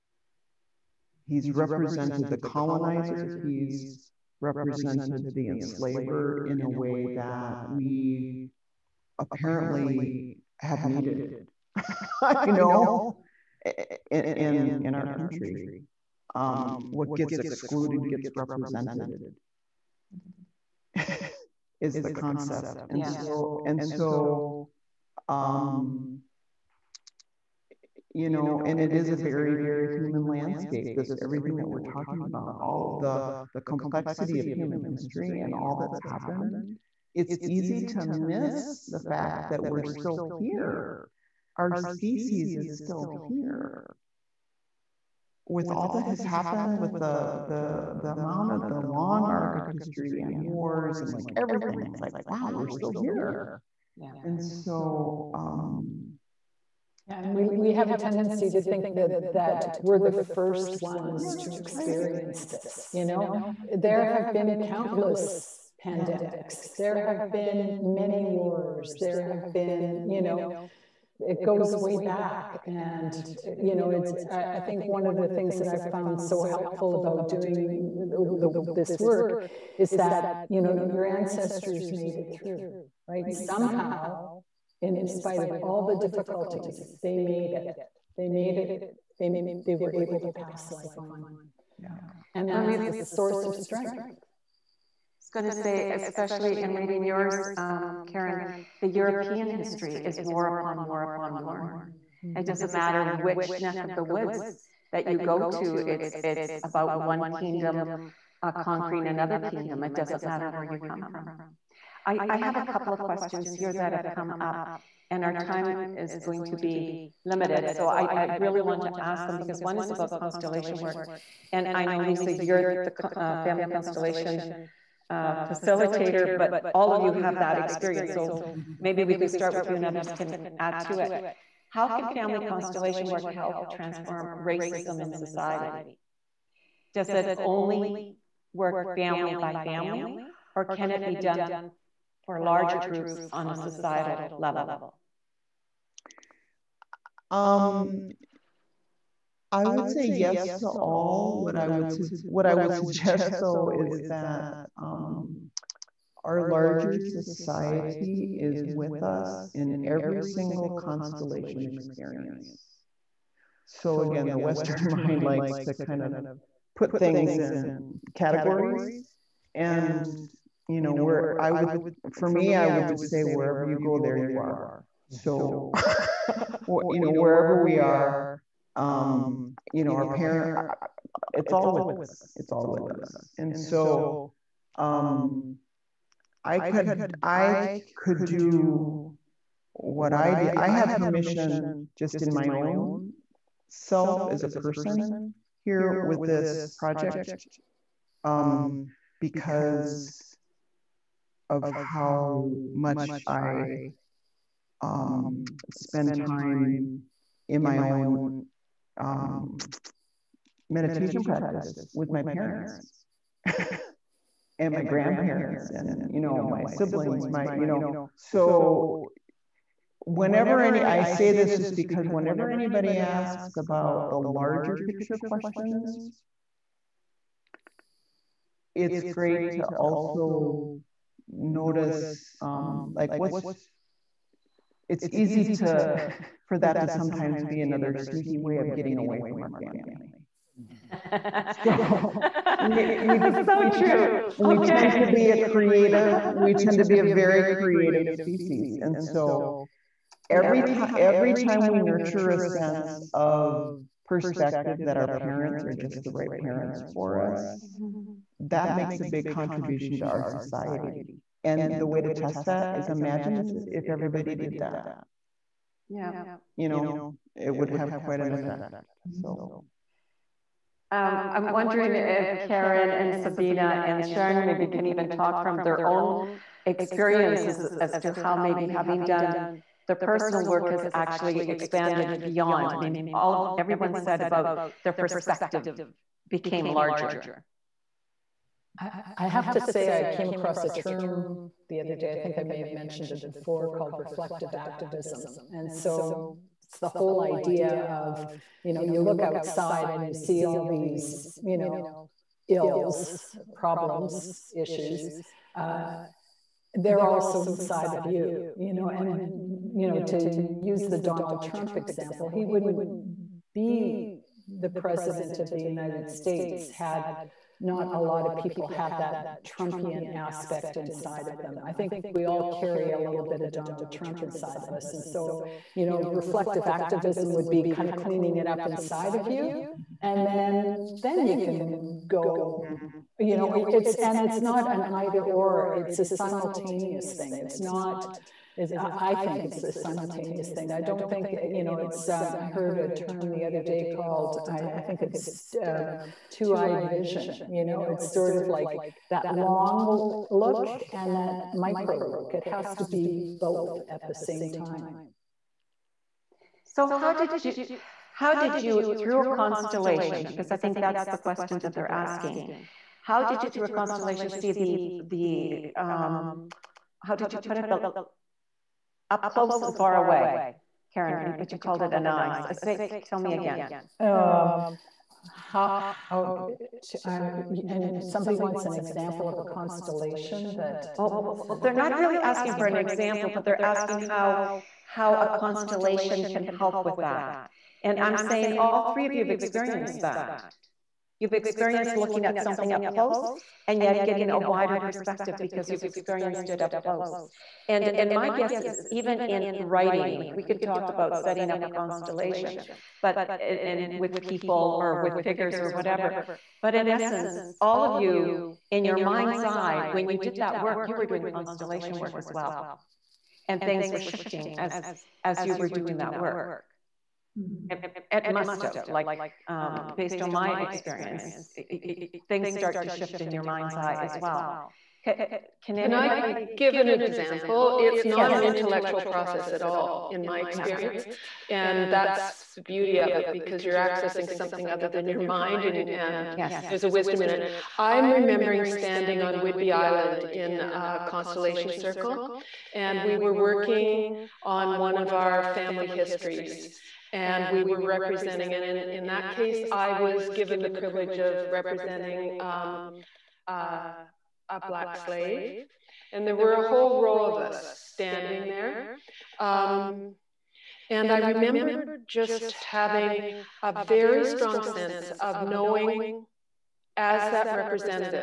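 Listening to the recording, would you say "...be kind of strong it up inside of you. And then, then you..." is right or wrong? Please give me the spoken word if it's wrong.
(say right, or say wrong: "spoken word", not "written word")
wrong: "cleaning", not "strong".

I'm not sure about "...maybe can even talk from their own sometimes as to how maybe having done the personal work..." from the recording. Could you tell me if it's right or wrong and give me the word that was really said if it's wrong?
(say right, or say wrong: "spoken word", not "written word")
wrong: "experiences", not "sometimes".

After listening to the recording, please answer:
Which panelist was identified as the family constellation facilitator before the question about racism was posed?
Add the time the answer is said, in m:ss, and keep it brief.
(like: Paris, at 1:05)
Lisa, at 2:01.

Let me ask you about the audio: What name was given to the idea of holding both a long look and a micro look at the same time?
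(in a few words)
two-eyed vision.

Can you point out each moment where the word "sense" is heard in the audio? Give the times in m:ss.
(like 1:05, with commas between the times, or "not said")
4:12, 7:44.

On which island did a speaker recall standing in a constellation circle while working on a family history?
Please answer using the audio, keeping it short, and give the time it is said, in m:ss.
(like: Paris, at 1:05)
Whidbey Island, at 7:19.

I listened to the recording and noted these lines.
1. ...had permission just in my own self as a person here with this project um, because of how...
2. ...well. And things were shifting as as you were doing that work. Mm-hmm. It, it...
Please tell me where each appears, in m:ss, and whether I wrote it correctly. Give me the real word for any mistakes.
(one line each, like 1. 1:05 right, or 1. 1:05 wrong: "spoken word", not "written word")
1. 3:10 right
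2. 6:52 right.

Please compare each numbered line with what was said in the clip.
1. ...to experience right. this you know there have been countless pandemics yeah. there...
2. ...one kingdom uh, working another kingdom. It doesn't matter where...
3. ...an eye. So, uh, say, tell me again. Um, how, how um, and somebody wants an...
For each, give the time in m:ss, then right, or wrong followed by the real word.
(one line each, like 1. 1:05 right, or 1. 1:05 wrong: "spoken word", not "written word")
1. 1:01 right
2. 1:46 wrong: "conquering", not "working"
3. 6:11 right.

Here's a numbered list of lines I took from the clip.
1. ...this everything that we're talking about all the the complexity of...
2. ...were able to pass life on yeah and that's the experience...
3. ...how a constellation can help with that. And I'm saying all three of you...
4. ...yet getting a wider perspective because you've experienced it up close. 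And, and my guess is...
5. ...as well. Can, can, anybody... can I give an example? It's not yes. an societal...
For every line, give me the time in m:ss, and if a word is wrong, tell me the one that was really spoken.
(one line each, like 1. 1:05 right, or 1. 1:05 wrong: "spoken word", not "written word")
1. 0:30 right
2. 1:29 wrong: "source", not "experience"
3. 6:24 right
4. 6:33 right
5. 7:04 wrong: "intellectual", not "societal".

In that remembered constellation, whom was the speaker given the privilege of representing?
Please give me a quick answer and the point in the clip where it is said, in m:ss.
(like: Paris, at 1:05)
a black slave, at 7:34.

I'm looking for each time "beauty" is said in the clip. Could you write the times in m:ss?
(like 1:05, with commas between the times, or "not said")
7:12.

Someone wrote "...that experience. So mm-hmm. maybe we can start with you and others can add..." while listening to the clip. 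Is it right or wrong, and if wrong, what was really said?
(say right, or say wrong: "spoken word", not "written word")
right.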